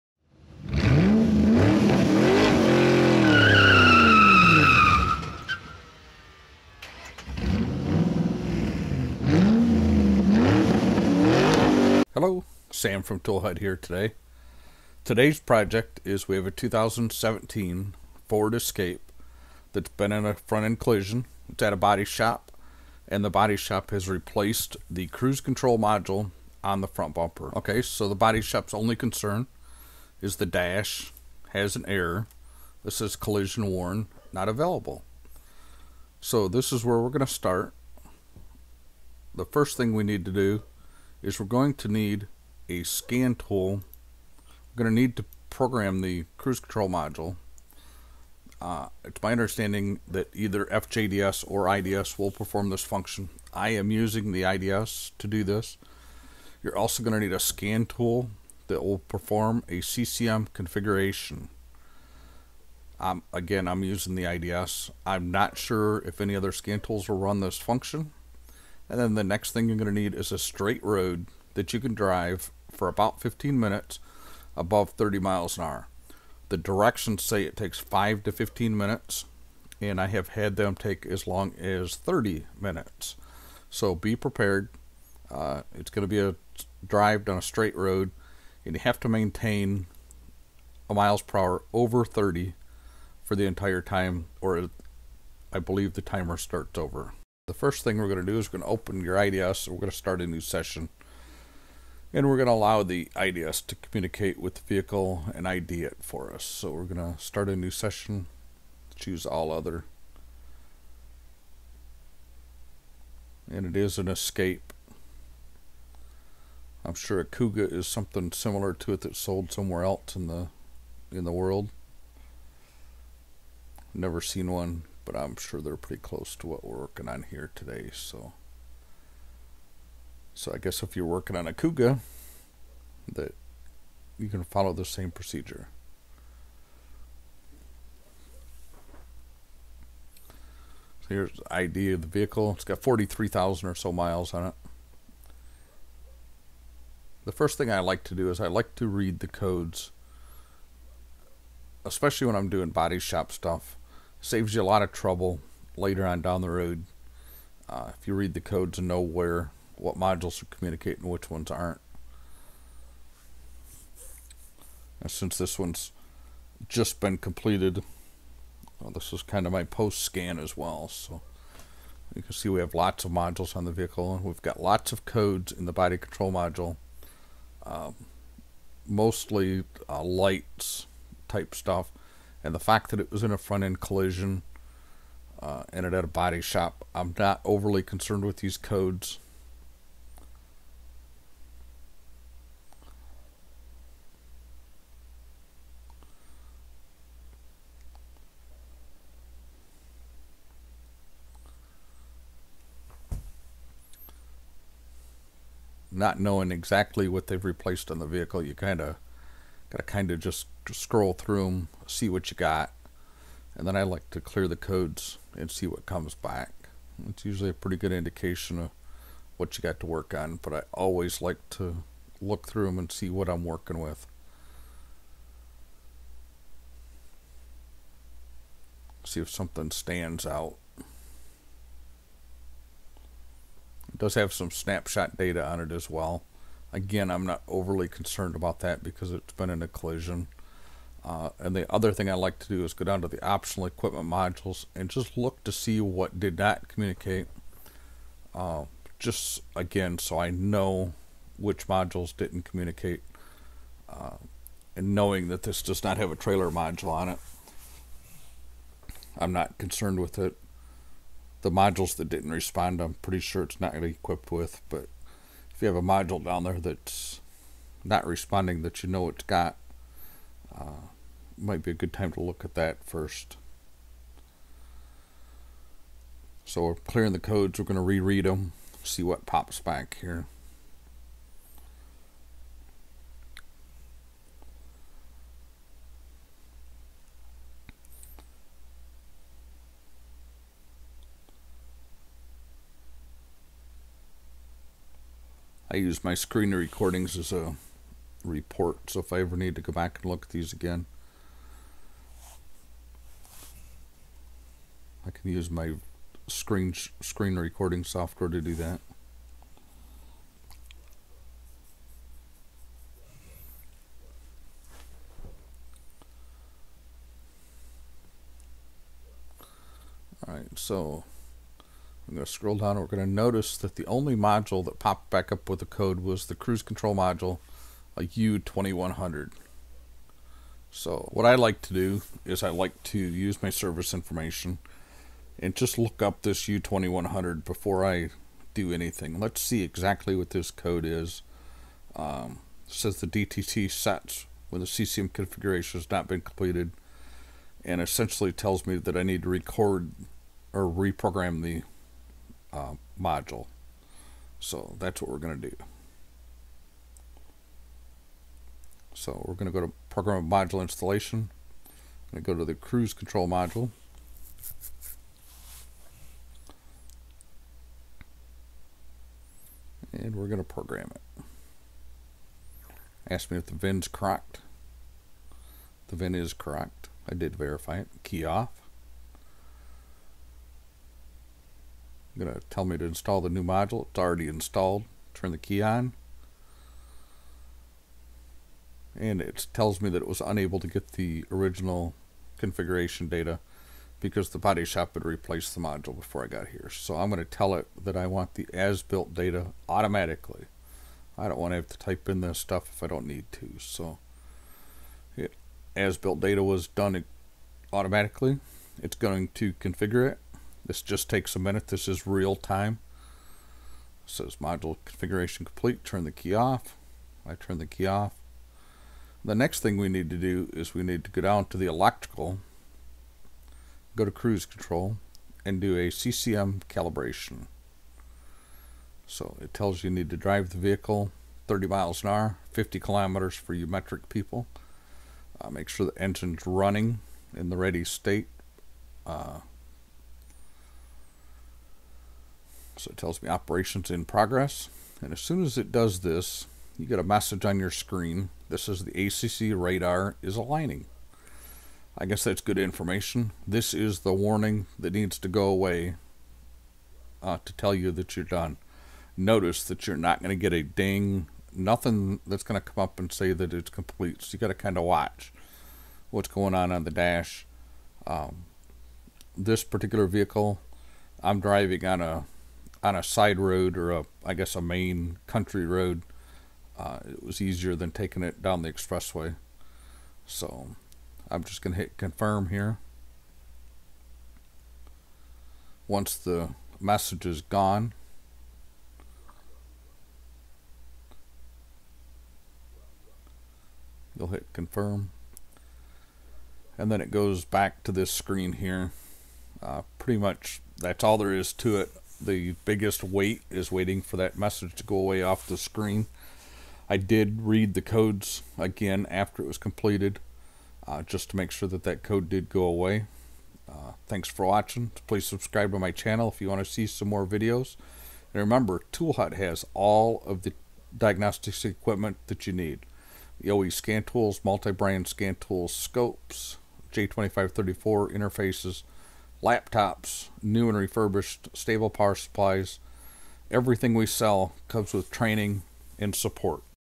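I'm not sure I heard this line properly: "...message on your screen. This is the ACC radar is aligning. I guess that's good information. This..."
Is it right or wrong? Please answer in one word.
right.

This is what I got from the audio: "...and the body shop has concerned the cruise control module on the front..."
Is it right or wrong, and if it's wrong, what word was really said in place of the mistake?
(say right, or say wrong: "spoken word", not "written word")
wrong: "replaced", not "concerned".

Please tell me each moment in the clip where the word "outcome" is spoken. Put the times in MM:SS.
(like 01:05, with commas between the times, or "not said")
not said.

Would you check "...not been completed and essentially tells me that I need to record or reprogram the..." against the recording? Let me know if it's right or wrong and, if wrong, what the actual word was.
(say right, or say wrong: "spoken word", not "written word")
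right.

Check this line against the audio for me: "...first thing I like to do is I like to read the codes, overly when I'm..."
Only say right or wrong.
wrong.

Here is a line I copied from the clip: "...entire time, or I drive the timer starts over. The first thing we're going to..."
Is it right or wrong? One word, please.
wrong.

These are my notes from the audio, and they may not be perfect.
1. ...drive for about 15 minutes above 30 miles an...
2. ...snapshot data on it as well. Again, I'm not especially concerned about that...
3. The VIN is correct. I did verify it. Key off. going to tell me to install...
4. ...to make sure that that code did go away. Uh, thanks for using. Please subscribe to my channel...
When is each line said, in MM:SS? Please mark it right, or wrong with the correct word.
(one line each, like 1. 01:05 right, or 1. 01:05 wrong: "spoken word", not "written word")
1. 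01:11 right
2. 03:54 wrong: "overly", not "especially"
3. 06:15 right
4. 08:31 wrong: "watching", not "using".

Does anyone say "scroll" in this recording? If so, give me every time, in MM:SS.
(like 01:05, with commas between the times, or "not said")
03:30, 05:22.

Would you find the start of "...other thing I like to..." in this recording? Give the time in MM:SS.
04:01.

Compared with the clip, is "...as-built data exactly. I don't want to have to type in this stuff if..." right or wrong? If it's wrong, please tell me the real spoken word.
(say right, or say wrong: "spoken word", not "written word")
wrong: "automatically", not "exactly".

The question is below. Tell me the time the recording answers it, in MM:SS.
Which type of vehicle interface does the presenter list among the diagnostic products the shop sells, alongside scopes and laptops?
08:46.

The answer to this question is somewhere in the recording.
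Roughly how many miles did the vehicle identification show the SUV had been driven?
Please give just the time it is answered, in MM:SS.
02:22.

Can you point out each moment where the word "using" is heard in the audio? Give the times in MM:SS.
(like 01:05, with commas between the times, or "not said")
00:53, 01:03.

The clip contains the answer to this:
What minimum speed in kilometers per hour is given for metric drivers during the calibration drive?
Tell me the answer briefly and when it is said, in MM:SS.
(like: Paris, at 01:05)
50, at 07:12.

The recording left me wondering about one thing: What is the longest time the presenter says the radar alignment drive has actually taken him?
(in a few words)
30 minutes.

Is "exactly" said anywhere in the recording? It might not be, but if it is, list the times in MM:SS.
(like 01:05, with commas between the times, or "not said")
03:26, 05:39.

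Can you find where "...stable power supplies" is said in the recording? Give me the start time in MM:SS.
08:51.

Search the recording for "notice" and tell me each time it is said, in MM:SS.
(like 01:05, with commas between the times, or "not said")
05:23, 07:39.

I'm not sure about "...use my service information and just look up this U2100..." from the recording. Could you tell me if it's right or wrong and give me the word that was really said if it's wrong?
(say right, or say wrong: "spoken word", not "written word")
right.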